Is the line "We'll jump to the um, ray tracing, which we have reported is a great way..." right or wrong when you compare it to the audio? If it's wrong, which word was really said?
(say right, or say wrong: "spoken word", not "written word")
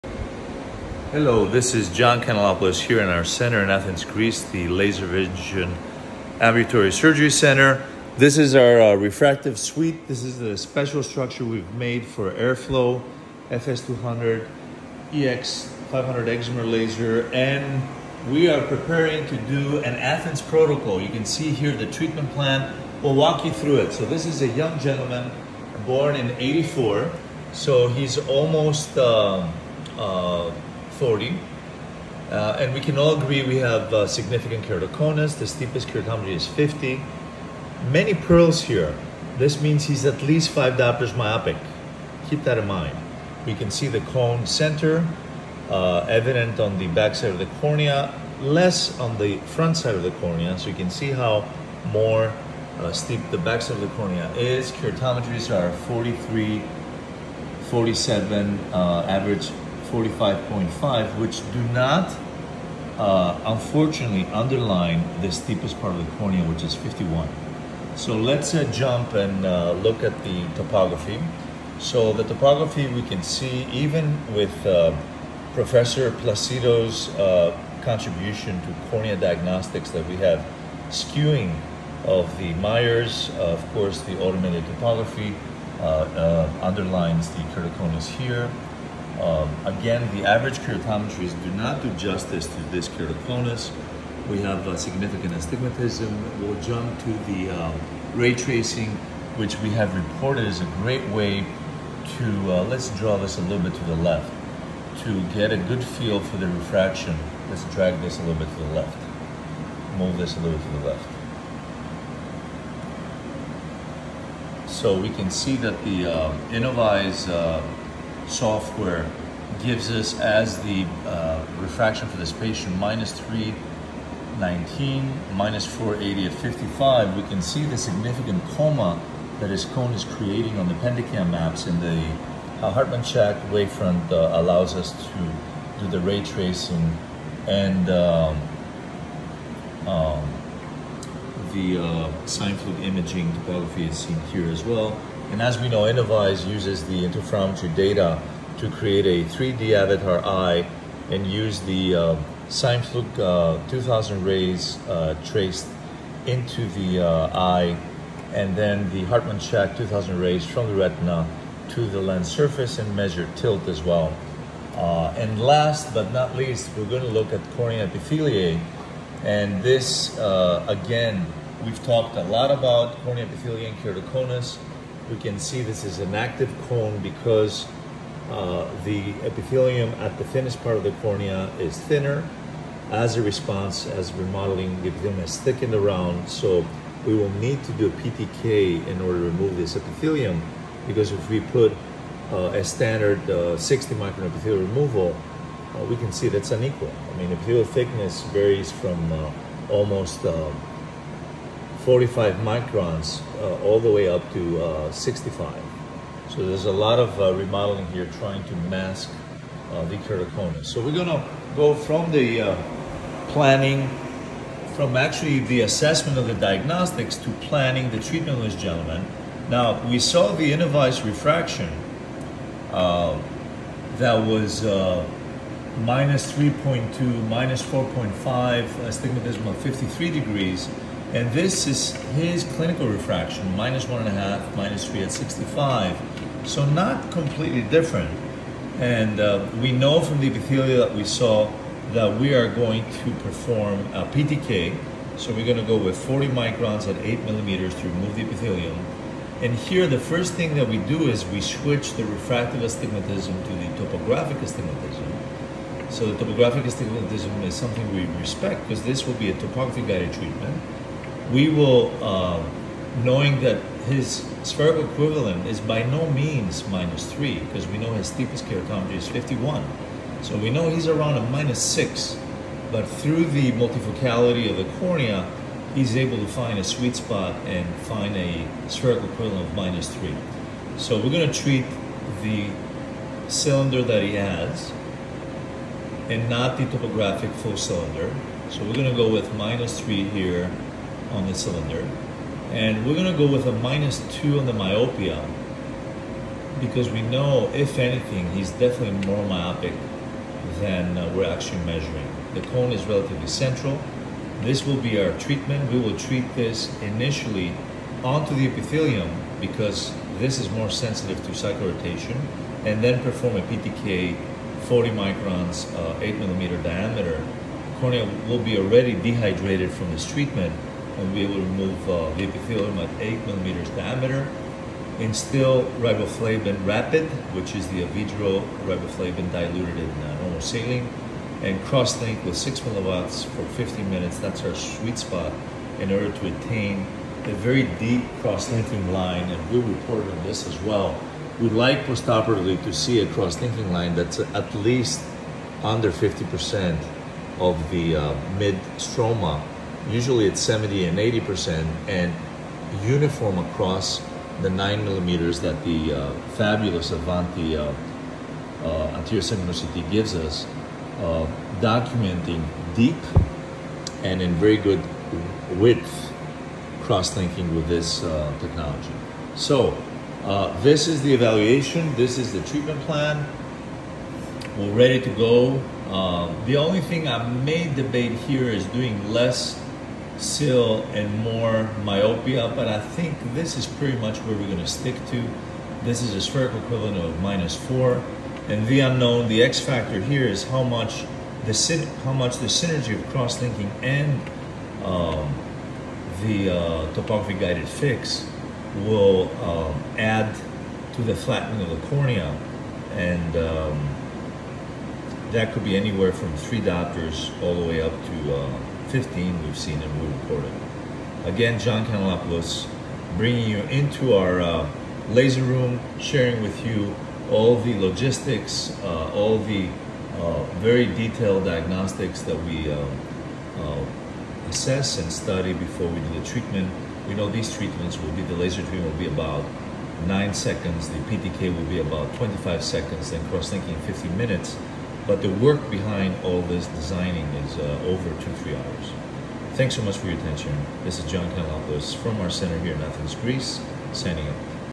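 right.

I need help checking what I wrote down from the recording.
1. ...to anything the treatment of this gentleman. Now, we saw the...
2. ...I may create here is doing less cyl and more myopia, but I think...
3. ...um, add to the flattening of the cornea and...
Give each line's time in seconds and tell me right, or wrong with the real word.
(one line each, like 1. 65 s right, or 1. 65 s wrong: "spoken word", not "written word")
1. 217 s wrong: "planning", not "anything"
2. 377 s wrong: "debate", not "create"
3. 399 s right.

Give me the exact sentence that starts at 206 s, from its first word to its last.
So there's a lot of uh, remodeling here trying to mask uh, the keratoconus.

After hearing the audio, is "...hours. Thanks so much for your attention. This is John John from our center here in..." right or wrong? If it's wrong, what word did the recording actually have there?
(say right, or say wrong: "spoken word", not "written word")
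wrong: "Kanellopoulos", not "John".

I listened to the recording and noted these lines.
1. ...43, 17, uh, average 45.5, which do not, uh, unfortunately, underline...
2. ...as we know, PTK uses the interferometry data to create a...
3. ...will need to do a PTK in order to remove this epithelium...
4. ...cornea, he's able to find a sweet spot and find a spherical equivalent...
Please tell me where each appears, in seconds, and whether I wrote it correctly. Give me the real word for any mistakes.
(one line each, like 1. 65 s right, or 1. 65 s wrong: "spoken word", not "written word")
1. 55 s wrong: "47", not "17"
2. 145 s wrong: "InnovEyes", not "PTK"
3. 187 s right
4. 274 s right.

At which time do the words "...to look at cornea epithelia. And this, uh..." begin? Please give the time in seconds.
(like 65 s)
167 s.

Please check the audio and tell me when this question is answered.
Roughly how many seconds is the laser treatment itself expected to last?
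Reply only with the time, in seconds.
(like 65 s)
430 s.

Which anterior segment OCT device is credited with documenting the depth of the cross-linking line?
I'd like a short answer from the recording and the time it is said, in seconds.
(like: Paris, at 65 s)
Avanti, at 356 s.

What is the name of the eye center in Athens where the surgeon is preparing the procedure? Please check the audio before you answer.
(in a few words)
Laser Vision Ambulatory Surgery Center.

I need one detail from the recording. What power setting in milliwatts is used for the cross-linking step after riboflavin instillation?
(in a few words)
6 milliwatts.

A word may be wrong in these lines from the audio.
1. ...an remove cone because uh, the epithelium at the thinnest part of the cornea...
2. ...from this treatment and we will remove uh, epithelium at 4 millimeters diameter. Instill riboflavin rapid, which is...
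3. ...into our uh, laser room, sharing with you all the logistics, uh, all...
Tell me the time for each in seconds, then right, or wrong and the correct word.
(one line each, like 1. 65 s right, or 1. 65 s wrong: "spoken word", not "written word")
1. 175 s wrong: "active", not "remove"
2. 319 s wrong: "8", not "4"
3. 413 s right.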